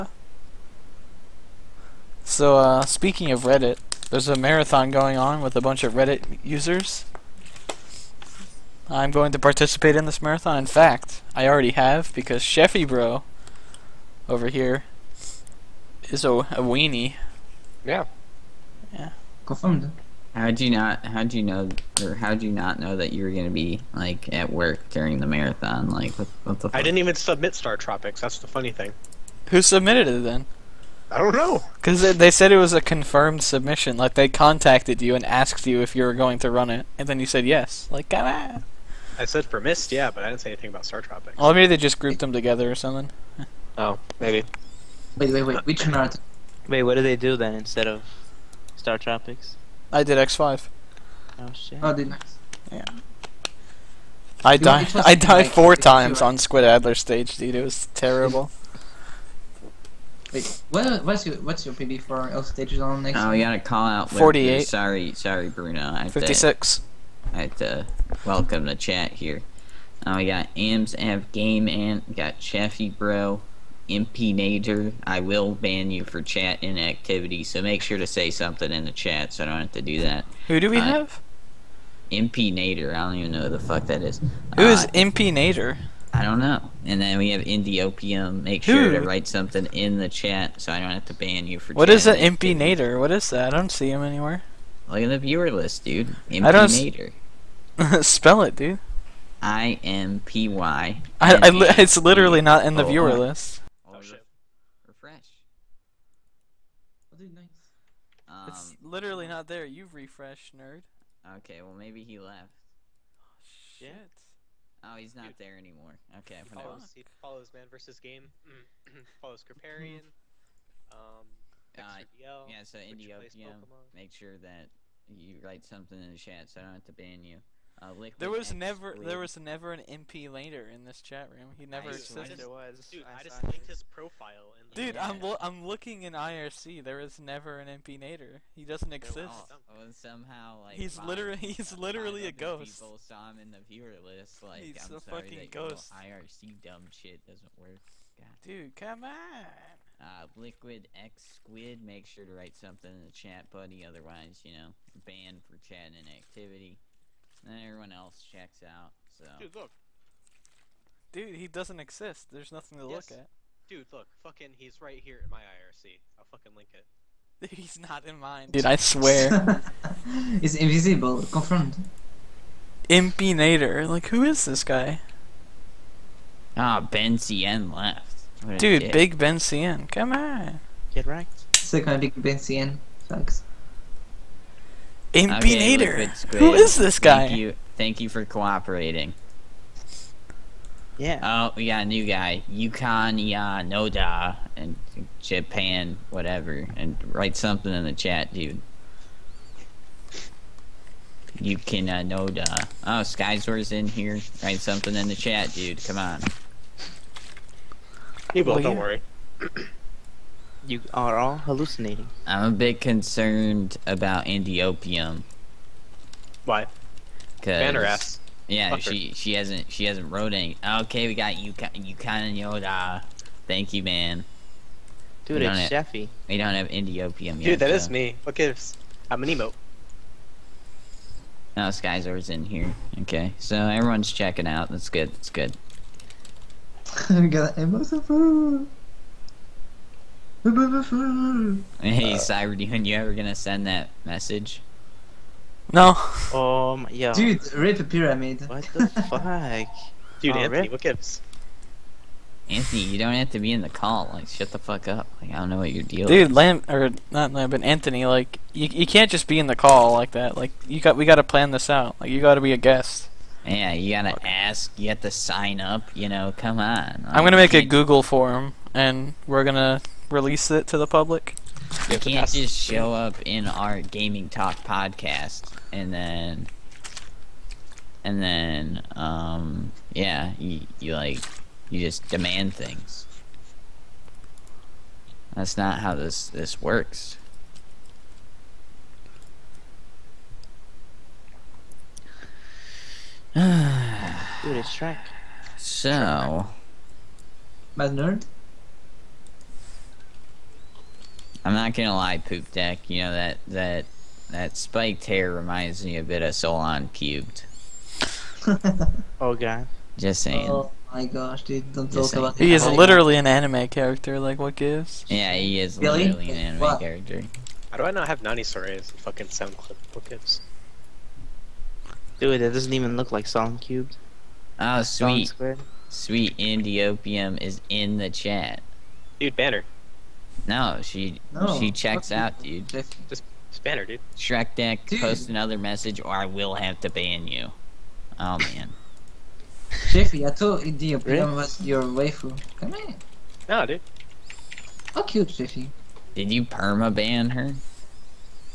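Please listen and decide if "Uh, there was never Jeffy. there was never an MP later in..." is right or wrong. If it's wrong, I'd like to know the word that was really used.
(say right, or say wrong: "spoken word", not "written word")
wrong: "Blade", not "Jeffy".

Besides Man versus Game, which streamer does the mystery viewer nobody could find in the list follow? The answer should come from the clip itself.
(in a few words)
Kriparian.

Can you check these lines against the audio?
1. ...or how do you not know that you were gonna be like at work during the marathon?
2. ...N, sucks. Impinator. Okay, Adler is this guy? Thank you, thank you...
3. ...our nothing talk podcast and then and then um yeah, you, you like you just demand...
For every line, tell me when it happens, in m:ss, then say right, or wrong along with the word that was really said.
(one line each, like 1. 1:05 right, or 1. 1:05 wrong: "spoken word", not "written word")
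1. 0:22 right
2. 3:02 wrong: "Who", not "Adler"
3. 4:33 wrong: "gaming", not "nothing".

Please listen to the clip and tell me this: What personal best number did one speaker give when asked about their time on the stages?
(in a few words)
48.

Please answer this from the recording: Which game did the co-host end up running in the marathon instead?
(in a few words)
X5.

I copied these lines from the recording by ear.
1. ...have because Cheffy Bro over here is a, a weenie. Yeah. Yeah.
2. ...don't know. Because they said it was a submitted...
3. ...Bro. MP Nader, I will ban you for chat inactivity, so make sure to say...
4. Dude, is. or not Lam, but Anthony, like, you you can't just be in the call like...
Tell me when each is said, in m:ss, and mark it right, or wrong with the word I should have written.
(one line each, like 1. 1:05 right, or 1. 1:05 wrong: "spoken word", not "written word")
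1. 0:11 right
2. 0:31 wrong: "confirmed", not "submitted"
3. 1:12 right
4. 4:16 right.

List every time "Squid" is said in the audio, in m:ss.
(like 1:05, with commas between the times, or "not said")
0:56, 2:31.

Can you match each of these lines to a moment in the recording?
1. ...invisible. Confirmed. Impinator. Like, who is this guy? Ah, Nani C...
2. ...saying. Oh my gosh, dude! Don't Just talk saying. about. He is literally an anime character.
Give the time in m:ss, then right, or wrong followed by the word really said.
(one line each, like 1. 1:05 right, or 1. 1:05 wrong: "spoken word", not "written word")
1. 2:50 wrong: "Ben", not "Nani"
2. 5:10 right.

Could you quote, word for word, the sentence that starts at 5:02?
You know that that that spiked hair reminds me a bit of Solon cubed.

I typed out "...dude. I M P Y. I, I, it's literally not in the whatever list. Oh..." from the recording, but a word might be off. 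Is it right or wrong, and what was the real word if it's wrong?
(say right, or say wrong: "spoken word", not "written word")
wrong: "viewer", not "whatever".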